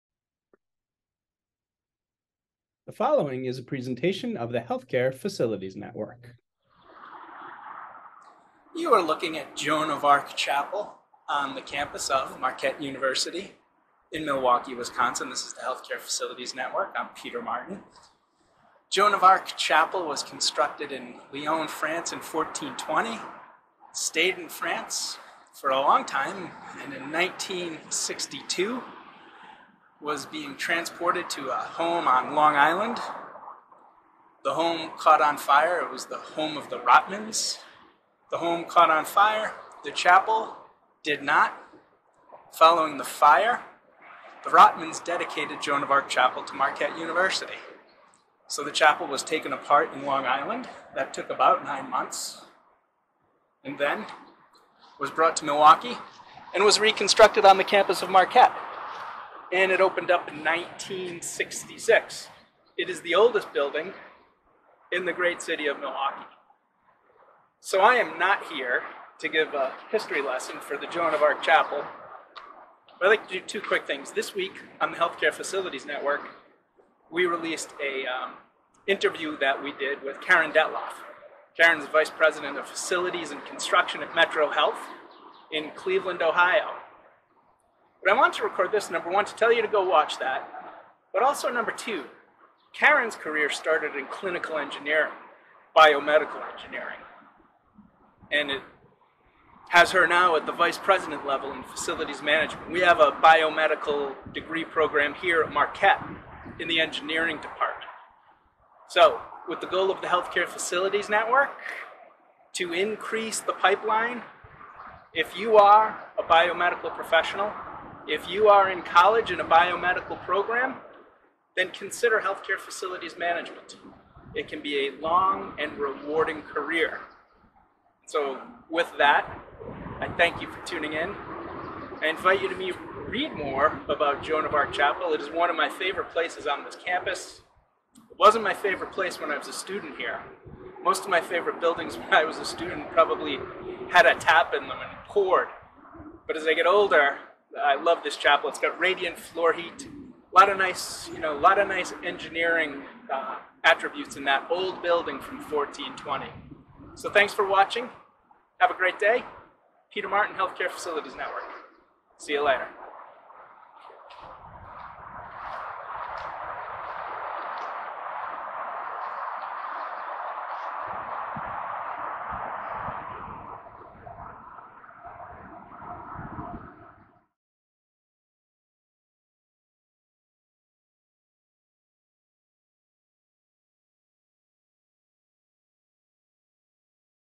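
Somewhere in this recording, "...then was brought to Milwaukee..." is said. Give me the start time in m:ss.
0:53.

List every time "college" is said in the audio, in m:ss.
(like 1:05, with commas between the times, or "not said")
1:58.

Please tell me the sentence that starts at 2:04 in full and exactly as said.
It can be a long and rewarding career.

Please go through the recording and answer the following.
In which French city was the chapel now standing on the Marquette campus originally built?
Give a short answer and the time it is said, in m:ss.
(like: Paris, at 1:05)
Lyon, at 0:21.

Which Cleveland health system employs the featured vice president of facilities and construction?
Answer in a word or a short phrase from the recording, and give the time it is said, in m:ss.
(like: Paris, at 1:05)
Metro Health, at 1:24.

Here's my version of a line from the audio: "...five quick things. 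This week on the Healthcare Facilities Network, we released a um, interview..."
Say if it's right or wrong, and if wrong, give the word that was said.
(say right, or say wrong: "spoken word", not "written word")
wrong: "two", not "five".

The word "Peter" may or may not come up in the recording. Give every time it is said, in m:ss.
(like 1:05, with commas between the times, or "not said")
0:17, 2:39.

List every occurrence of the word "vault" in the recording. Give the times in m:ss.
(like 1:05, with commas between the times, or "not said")
not said.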